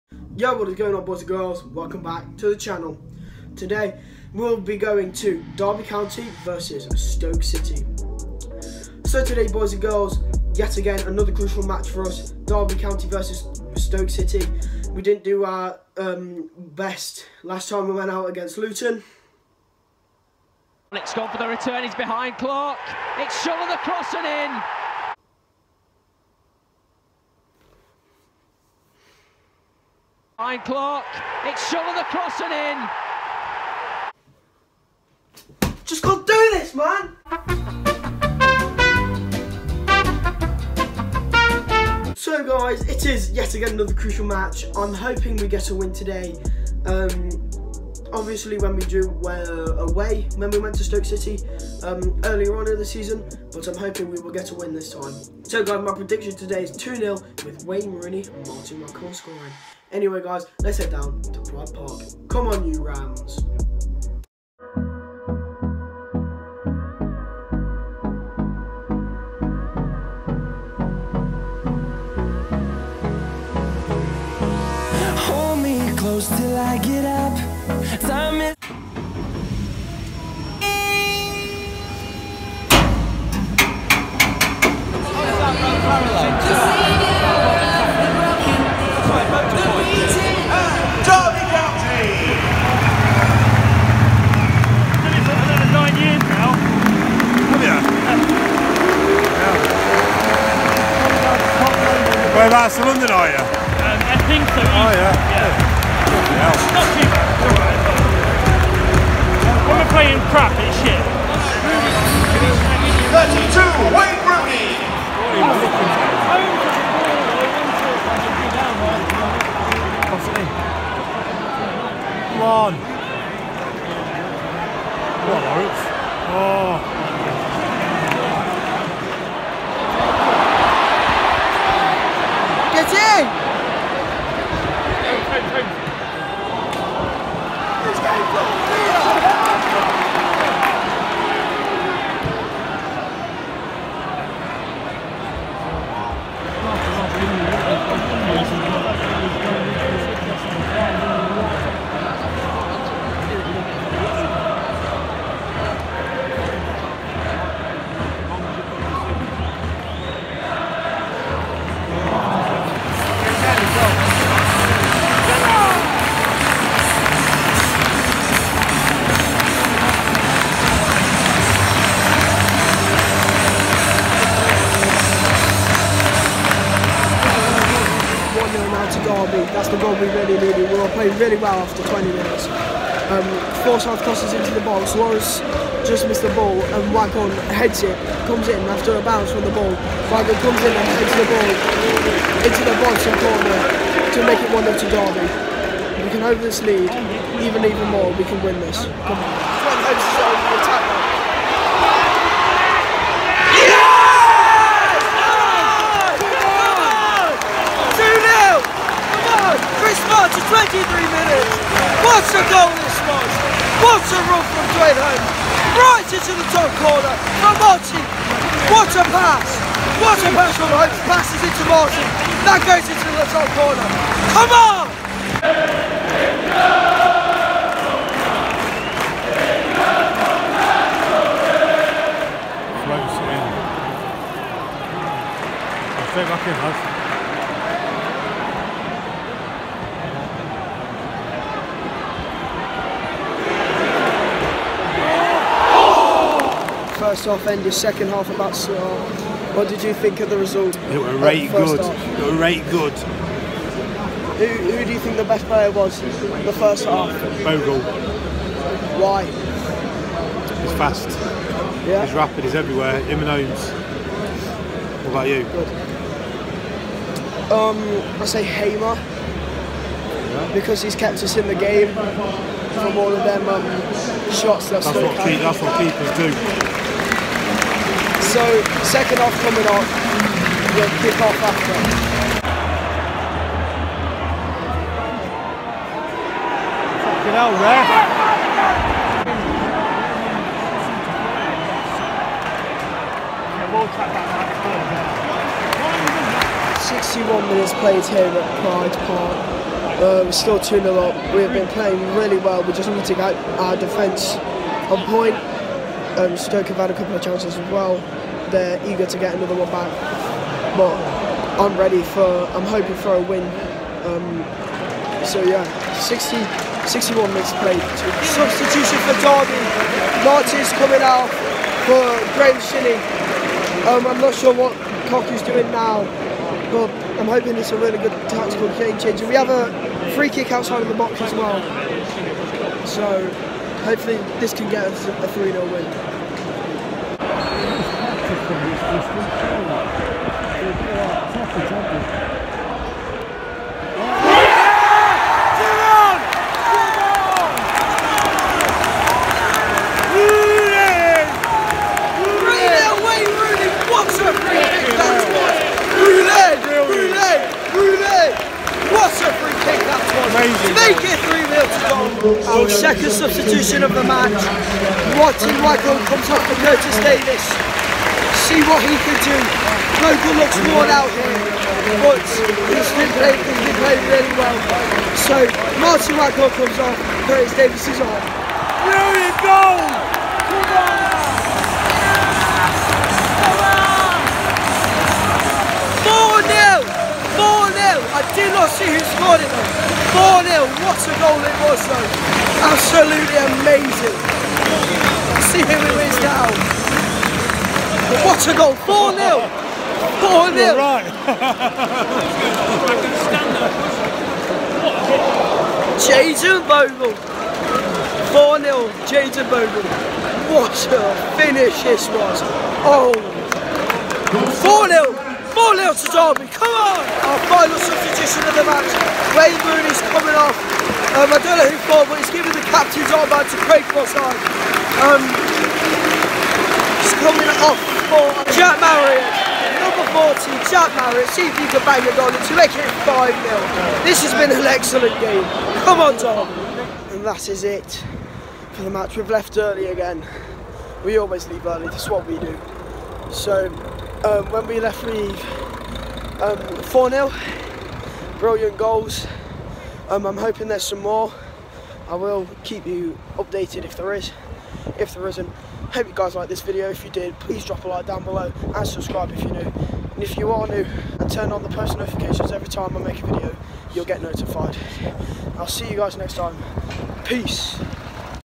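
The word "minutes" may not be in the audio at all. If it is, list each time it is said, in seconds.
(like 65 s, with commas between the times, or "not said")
182 s, 297 s, 317 s.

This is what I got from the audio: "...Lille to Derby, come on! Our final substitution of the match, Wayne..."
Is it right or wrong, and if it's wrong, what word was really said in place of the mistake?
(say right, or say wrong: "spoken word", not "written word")
right.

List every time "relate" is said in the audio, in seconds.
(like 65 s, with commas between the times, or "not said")
not said.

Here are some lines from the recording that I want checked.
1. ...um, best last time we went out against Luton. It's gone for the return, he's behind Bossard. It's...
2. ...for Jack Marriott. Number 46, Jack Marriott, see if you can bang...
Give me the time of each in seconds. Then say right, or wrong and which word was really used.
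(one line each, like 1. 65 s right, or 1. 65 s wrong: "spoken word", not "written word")
1. 15 s wrong: "Clark", not "Bossard"
2. 428 s wrong: "40", not "46".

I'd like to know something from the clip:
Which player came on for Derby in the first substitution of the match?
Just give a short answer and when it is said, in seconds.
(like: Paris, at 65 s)
Graeme Shinnie, at 322 s.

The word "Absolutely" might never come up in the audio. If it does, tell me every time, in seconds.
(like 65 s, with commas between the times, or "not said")
392 s.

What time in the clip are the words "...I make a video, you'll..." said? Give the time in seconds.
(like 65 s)
462 s.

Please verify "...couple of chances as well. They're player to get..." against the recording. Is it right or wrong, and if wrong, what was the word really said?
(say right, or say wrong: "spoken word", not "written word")
wrong: "eager", not "player".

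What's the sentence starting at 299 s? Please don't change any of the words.
Uh, um, we're still 2 0 up.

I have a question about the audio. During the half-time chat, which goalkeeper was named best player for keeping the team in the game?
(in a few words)
Hamer.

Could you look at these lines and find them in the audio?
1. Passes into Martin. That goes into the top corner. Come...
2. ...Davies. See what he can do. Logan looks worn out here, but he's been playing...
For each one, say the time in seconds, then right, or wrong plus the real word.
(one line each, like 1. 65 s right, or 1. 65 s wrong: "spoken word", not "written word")
1. 221 s right
2. 366 s right.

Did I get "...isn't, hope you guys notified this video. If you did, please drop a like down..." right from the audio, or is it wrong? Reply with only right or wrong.
wrong.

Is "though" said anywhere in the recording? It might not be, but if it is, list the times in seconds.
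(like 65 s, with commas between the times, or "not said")
391 s.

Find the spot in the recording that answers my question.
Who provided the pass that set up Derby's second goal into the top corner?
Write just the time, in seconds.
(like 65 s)
214 s.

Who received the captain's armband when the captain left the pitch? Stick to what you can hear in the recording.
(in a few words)
Craig Bossard.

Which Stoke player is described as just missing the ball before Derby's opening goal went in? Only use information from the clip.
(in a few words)
Suarez.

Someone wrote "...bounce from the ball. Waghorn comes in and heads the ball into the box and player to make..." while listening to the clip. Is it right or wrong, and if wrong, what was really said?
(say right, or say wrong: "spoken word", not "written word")
wrong: "corner", not "player".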